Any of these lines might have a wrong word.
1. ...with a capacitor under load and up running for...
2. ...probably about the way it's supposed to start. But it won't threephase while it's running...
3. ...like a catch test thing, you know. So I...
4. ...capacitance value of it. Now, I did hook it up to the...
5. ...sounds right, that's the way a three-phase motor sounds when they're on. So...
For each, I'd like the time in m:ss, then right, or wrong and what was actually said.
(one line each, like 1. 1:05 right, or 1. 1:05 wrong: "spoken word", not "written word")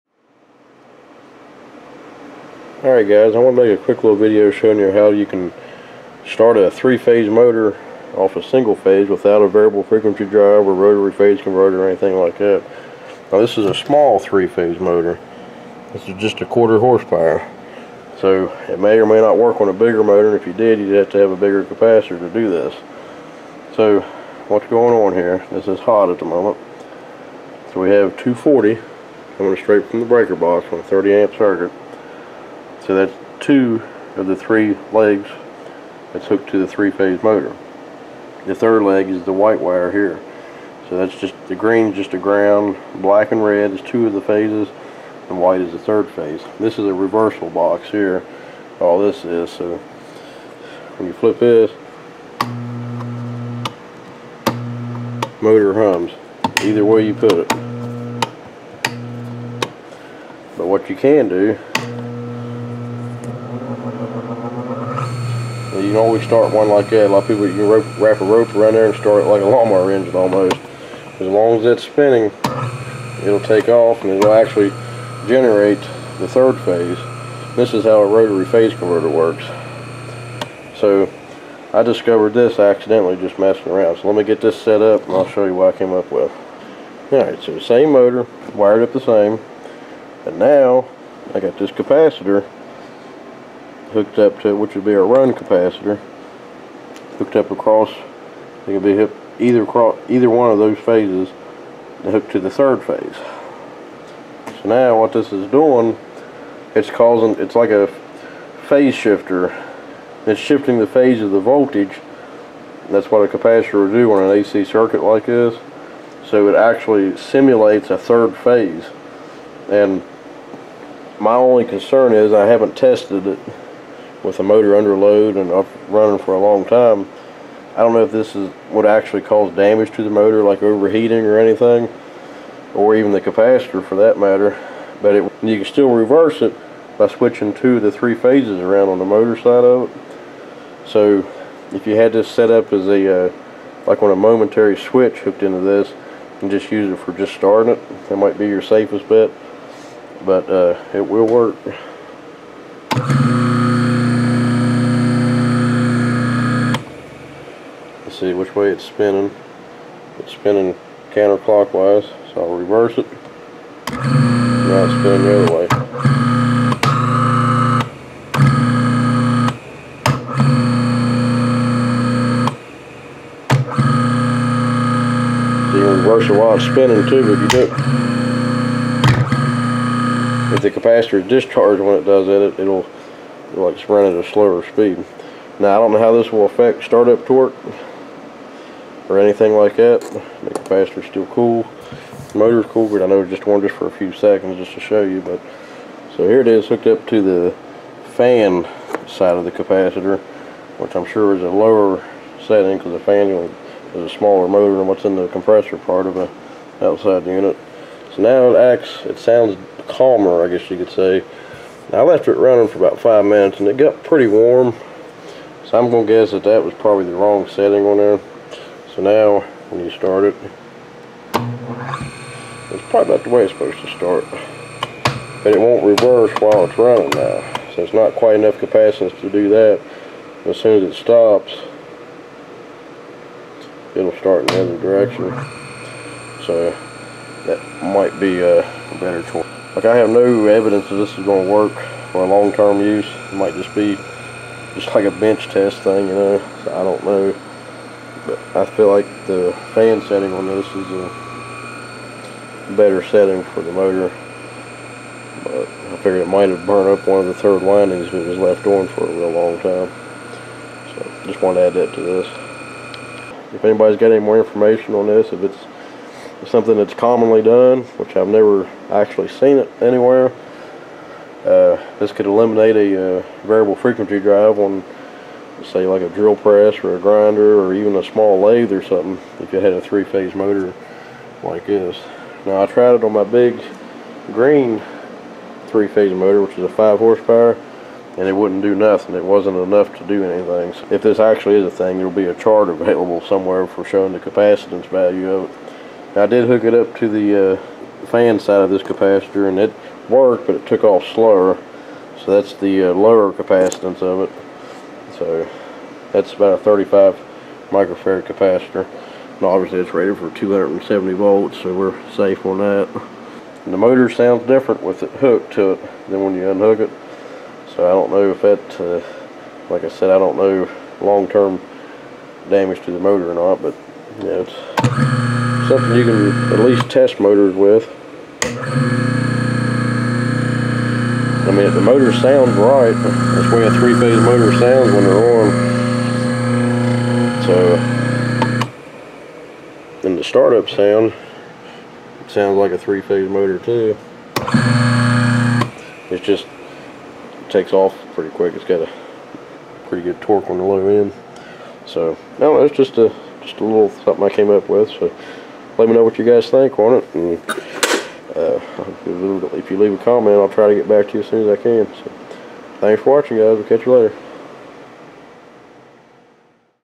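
1. 2:04 wrong: "motor", not "capacitor"
2. 3:42 wrong: "reverse", not "threephase"
3. 4:04 wrong: "bench", not "catch"
4. 4:54 right
5. 5:32 right.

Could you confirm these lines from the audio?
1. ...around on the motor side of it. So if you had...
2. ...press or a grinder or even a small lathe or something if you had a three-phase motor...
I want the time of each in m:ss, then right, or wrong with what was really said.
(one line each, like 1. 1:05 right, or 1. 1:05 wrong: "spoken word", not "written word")
1. 2:18 right
2. 4:36 right.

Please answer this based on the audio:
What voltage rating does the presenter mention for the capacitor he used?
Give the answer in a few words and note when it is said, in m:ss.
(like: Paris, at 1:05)
270 volts, at 5:10.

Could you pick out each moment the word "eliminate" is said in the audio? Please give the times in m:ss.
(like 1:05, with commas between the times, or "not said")
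4:32.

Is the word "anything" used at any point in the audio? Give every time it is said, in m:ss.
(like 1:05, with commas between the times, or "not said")
0:11, 2:11, 3:09, 4:50.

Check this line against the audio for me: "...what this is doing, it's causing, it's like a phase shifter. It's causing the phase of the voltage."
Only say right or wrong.
wrong.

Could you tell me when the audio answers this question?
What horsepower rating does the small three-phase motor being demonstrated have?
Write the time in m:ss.
0:16.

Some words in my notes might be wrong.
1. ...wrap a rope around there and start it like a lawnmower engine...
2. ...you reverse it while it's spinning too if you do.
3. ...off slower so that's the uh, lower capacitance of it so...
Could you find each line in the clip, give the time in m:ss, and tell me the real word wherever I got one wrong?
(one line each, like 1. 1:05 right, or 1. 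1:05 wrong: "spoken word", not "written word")
1. 1:07 right
2. 2:55 right
3. 5:00 right.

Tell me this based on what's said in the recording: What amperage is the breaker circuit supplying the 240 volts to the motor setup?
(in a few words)
30 amp.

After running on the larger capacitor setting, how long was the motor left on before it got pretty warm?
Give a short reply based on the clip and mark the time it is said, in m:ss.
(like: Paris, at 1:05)
About five minutes, at 3:32.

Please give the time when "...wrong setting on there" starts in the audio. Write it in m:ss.
3:37.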